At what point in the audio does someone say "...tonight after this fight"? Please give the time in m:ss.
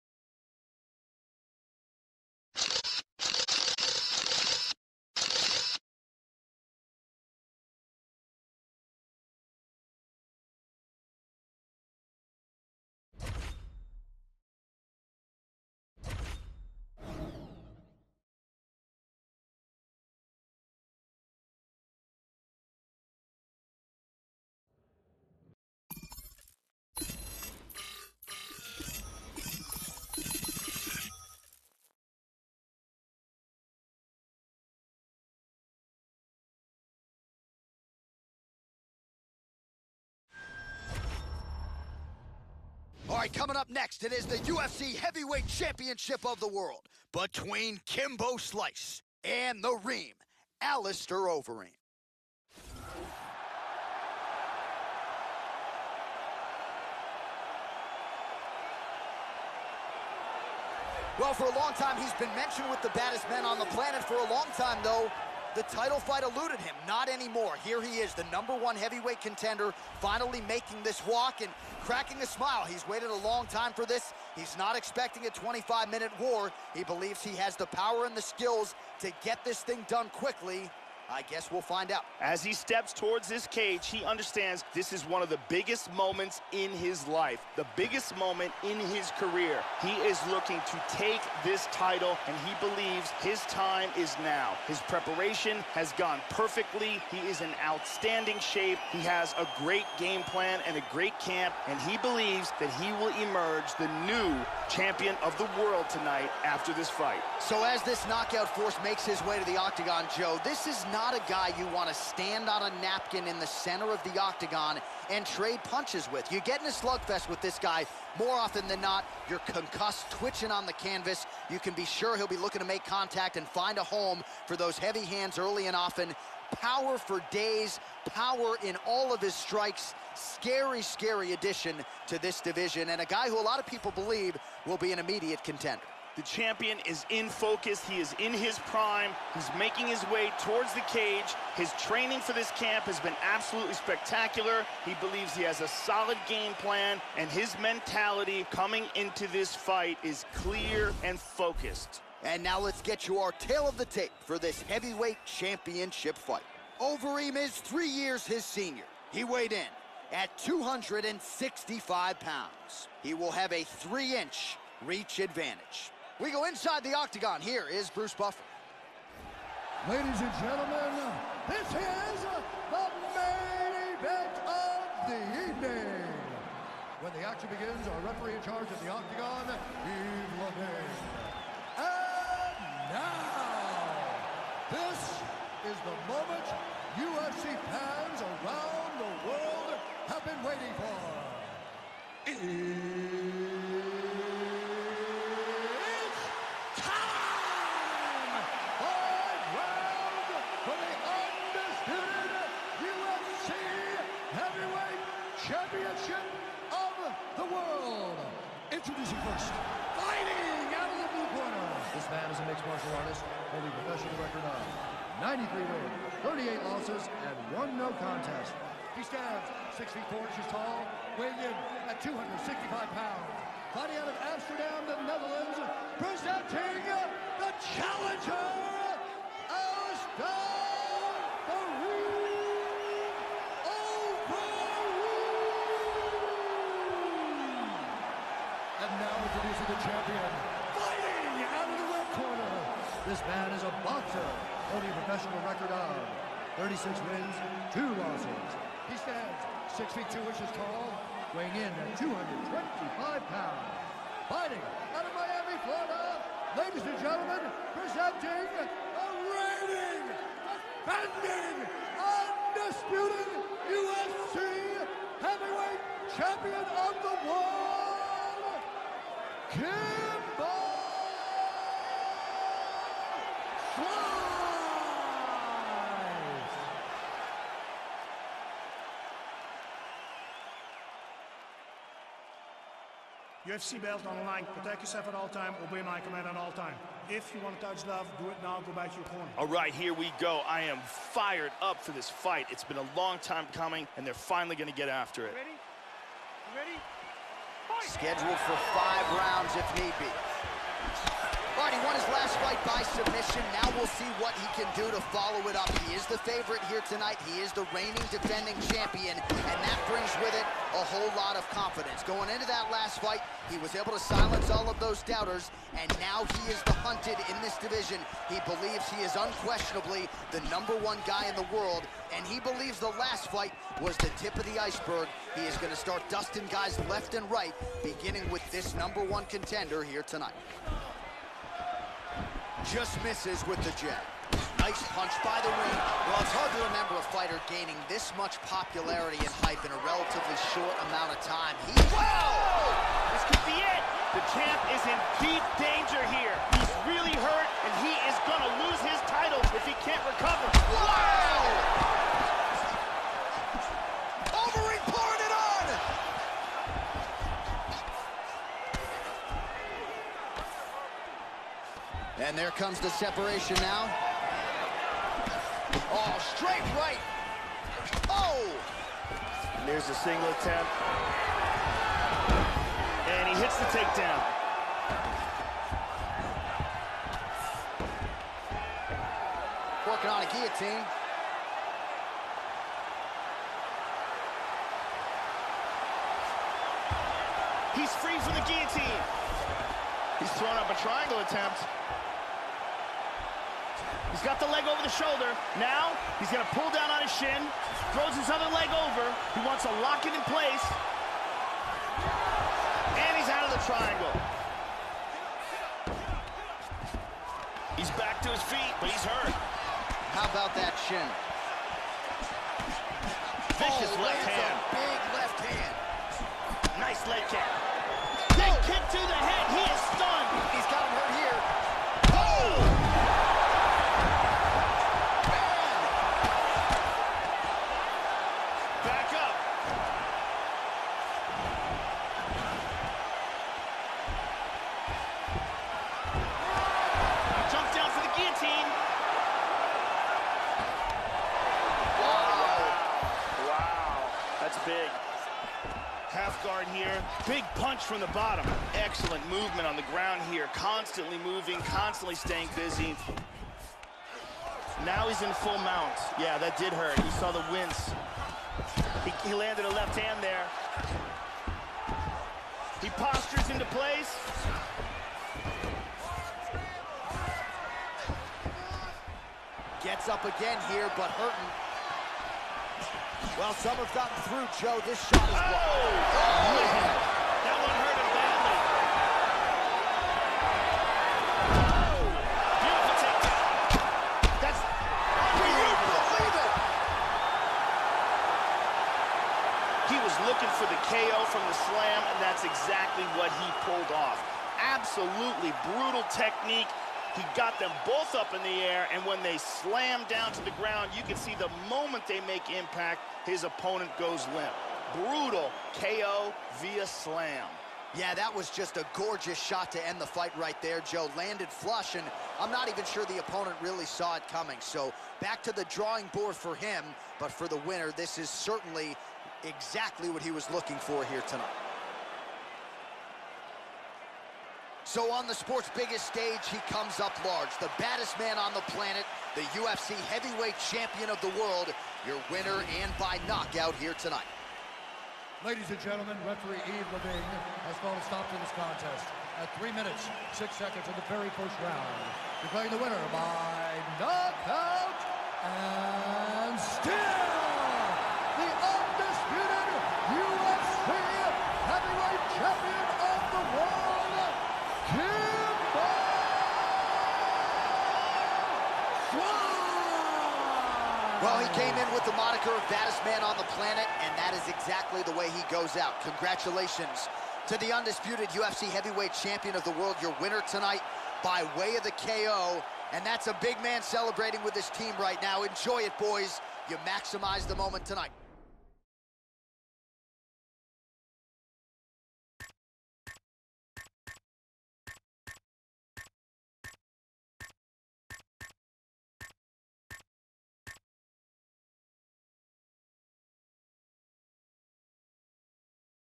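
1:45.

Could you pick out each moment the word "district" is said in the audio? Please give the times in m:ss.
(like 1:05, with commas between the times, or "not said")
not said.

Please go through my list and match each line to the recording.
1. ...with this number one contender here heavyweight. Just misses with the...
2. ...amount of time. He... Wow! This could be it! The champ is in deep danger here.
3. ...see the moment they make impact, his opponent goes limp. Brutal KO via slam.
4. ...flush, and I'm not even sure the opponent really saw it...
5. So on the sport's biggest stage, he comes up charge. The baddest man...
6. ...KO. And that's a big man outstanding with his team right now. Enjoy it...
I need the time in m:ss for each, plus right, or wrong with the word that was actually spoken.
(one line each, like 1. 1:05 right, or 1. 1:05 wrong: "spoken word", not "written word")
1. 5:28 wrong: "tonight", not "heavyweight"
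2. 5:40 right
3. 8:21 right
4. 8:31 right
5. 8:44 wrong: "large", not "charge"
6. 9:31 wrong: "celebrating", not "outstanding".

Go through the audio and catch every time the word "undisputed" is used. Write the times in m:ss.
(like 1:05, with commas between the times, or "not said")
4:21, 9:27.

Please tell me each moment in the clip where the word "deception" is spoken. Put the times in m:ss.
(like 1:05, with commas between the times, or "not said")
not said.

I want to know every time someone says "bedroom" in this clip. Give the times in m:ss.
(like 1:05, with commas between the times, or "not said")
not said.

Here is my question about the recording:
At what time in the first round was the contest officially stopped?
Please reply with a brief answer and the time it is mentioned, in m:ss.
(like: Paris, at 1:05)
3 minutes, 6 seconds, at 8:59.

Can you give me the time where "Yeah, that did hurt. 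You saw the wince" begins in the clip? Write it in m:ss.
7:36.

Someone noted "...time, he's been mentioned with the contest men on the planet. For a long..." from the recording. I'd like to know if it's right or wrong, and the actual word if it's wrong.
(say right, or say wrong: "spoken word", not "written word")
wrong: "baddest", not "contest".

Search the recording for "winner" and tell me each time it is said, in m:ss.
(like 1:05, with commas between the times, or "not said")
8:37, 8:52, 9:02, 9:30.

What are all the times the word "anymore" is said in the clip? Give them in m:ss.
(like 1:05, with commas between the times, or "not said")
1:07.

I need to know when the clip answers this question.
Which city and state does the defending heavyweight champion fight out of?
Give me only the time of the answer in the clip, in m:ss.
4:15.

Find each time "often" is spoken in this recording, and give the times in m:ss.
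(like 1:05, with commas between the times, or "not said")
1:58, 2:05.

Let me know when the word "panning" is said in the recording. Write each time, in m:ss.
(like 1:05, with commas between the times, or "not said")
not said.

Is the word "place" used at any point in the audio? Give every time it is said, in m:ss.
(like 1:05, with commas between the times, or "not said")
6:40, 7:43.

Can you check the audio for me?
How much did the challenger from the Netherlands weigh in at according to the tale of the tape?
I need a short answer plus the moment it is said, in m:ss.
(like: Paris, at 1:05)
265 pounds, at 2:39.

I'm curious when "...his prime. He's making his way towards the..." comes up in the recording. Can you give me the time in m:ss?
2:18.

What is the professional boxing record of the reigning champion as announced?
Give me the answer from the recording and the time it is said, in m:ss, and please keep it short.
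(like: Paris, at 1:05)
36 wins, 2 losses, at 4:06.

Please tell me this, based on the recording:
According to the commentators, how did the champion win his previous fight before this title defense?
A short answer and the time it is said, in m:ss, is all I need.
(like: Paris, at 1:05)
By submission, at 5:02.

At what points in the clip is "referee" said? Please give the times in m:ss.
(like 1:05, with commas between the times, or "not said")
2:58, 8:56.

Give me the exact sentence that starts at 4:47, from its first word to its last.
If you want to touch love, do it now.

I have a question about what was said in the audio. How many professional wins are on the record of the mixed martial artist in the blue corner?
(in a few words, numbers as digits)
93.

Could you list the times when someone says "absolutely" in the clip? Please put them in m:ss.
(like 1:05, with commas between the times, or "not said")
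2:23, 8:14.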